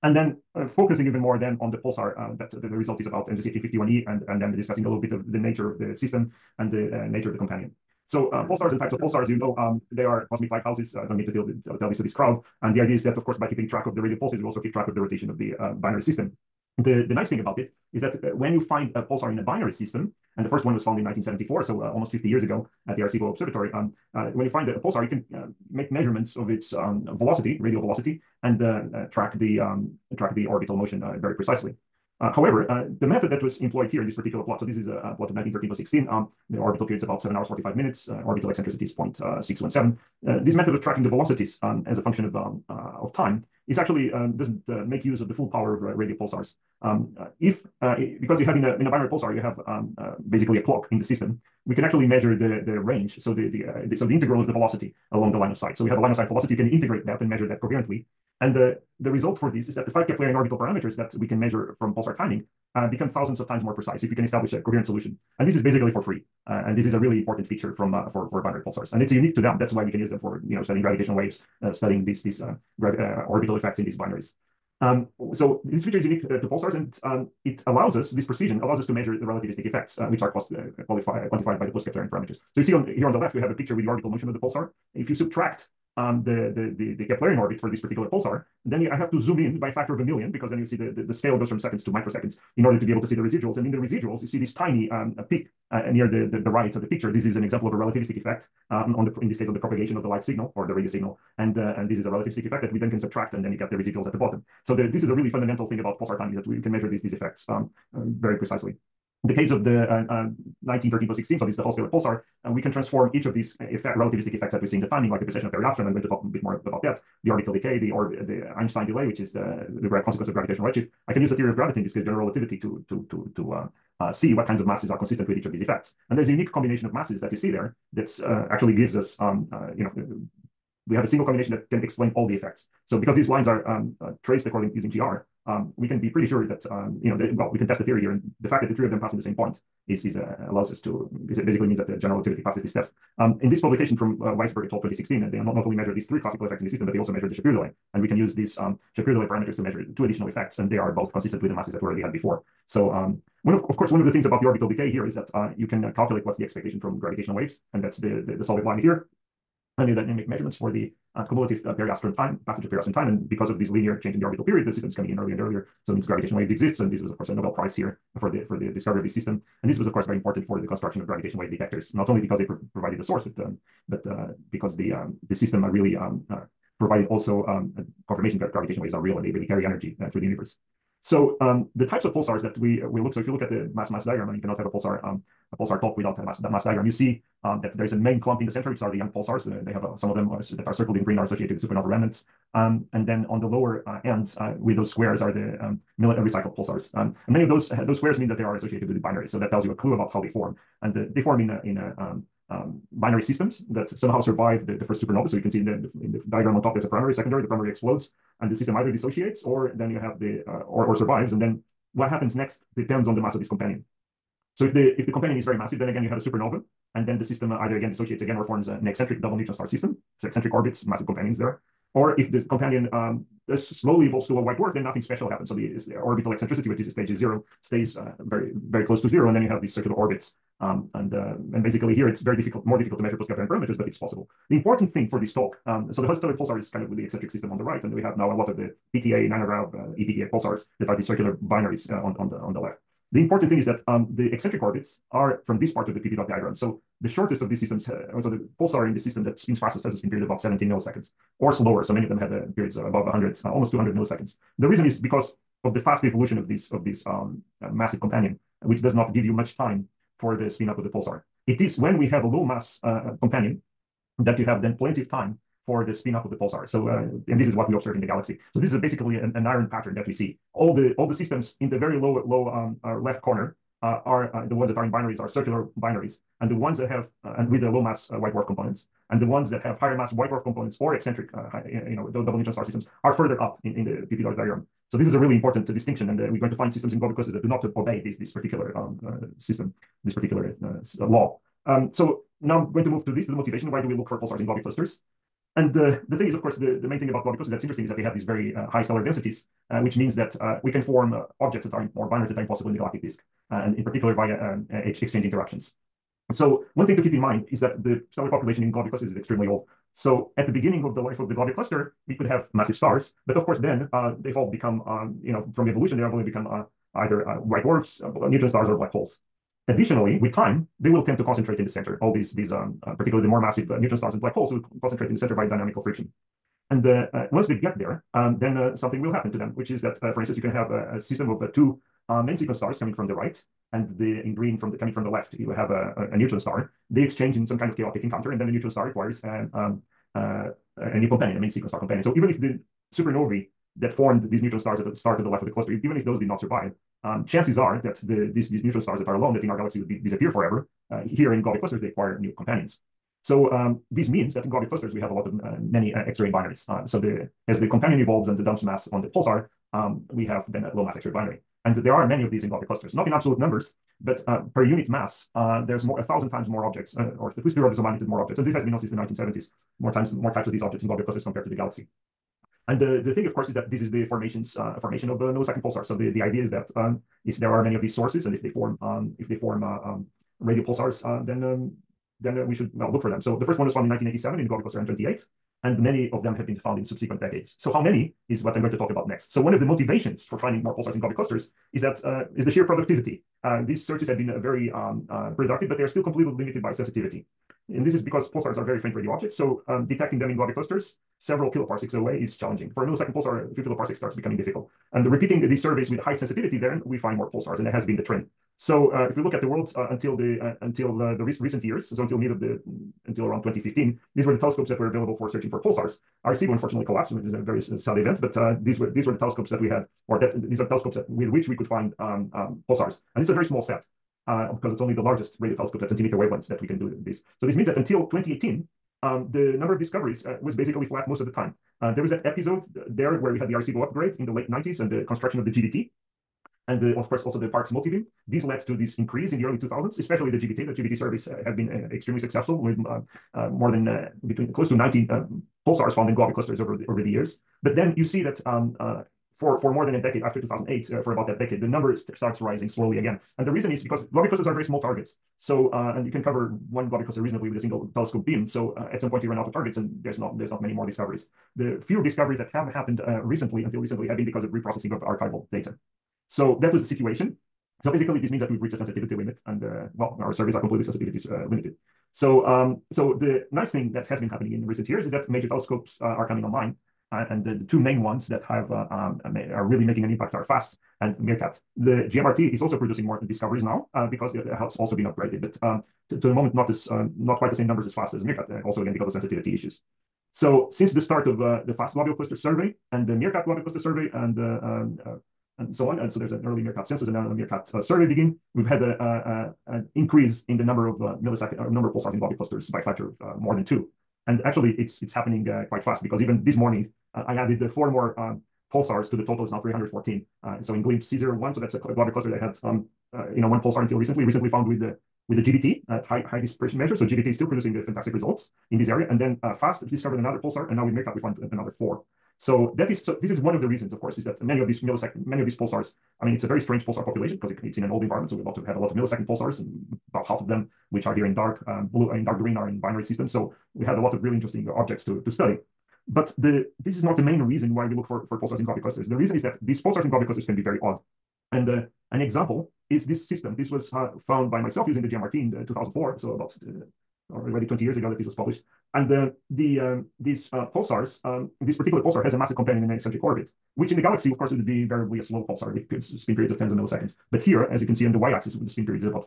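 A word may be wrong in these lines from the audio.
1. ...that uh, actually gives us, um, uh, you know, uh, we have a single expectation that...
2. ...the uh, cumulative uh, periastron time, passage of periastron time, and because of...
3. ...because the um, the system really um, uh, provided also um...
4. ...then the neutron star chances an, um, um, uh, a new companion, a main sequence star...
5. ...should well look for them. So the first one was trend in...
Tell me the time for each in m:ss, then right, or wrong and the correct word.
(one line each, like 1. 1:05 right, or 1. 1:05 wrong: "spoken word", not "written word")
1. 2:07 wrong: "combination", not "expectation"
2. 2:40 right
3. 2:54 right
4. 5:38 wrong: "acquires", not "chances"
5. 6:22 wrong: "found", not "trend".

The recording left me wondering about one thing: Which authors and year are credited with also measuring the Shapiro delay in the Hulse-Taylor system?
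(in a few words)
Weisberg et al. 2016.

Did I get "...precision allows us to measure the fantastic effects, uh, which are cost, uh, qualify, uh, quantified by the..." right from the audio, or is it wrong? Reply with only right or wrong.
wrong.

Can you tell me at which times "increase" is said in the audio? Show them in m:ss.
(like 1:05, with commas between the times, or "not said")
7:18, 8:19.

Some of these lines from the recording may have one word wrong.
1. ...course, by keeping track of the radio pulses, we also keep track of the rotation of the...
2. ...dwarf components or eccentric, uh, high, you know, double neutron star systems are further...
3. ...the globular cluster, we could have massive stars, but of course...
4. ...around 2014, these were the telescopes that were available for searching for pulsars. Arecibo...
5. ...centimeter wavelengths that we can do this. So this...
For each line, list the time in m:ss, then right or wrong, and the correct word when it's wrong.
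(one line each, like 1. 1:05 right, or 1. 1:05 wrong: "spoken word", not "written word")
1. 0:13 right
2. 4:40 right
3. 5:11 right
4. 6:53 wrong: "2015", not "2014"
5. 7:05 right.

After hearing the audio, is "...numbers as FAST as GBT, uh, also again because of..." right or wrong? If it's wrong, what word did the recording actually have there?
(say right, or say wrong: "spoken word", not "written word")
wrong: "MeerKAT", not "GBT".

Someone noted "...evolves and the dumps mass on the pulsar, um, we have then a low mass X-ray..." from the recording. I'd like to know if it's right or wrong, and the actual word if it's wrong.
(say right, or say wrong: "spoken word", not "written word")
right.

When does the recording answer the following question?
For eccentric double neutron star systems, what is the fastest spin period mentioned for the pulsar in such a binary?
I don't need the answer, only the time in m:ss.
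4:10.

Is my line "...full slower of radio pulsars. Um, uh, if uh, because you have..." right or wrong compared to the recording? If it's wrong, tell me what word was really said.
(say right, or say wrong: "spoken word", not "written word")
wrong: "power", not "slower".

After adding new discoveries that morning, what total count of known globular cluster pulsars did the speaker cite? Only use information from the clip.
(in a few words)
314.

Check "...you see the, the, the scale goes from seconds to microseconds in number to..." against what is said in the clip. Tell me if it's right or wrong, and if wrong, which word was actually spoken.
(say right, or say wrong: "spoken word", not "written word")
wrong: "order", not "number".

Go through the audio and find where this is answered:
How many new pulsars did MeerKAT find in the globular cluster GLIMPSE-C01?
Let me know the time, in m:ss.
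8:41.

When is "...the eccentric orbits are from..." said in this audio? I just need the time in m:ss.
4:04.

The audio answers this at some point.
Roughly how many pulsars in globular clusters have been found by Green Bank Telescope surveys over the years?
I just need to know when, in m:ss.
7:24.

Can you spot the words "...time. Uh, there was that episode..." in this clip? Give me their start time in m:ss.
7:11.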